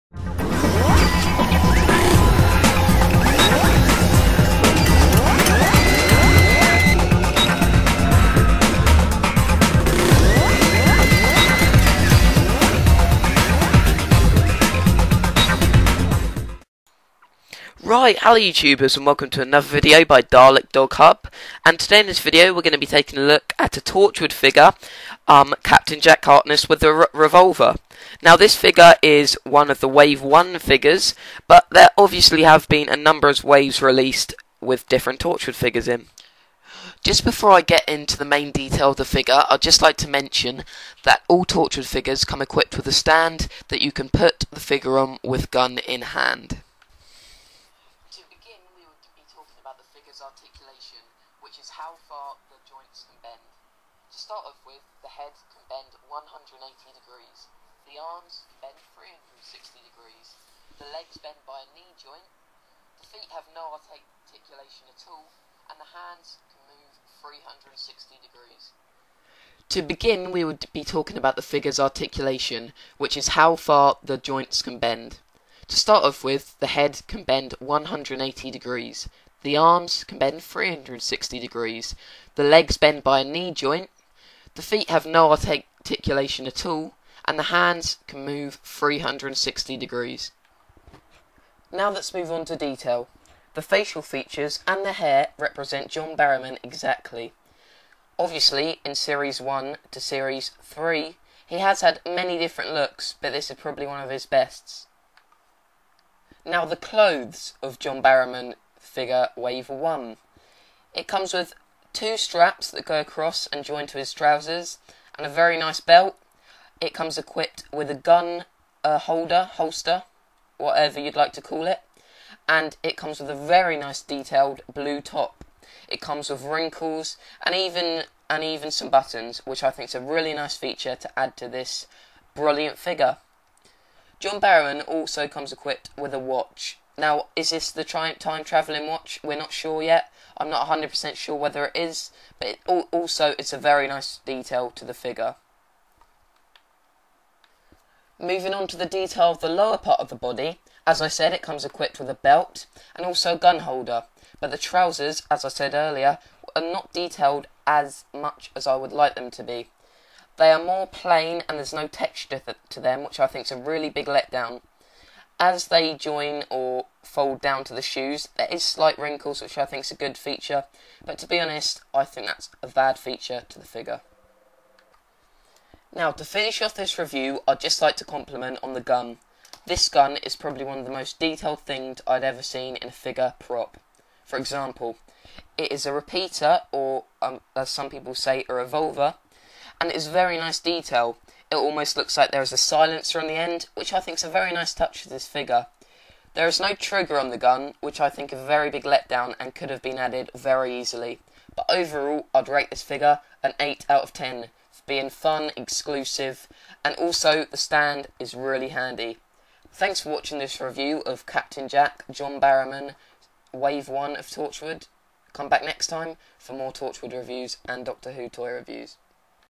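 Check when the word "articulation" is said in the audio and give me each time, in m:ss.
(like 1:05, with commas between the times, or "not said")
0:50, 1:03, 1:11, 1:25.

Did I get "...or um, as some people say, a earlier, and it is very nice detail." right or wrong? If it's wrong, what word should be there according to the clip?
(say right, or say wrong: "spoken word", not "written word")
wrong: "revolver", not "earlier".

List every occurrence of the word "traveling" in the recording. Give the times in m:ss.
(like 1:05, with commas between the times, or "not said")
2:18.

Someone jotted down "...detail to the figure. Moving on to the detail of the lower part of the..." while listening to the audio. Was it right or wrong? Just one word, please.
right.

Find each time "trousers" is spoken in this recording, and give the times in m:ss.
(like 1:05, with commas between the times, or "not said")
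1:54, 2:34.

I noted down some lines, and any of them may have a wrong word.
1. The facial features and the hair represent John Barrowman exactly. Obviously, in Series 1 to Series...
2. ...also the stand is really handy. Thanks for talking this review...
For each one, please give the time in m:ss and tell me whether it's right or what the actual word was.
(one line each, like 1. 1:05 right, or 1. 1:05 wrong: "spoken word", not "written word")
1. 1:33 right
2. 3:26 wrong: "watching", not "talking".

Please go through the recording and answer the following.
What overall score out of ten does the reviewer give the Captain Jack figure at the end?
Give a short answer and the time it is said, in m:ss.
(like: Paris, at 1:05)
8, at 3:23.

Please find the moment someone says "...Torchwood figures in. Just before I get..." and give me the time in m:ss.
0:35.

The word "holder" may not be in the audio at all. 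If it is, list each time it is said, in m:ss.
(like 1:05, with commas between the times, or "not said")
1:58, 2:33.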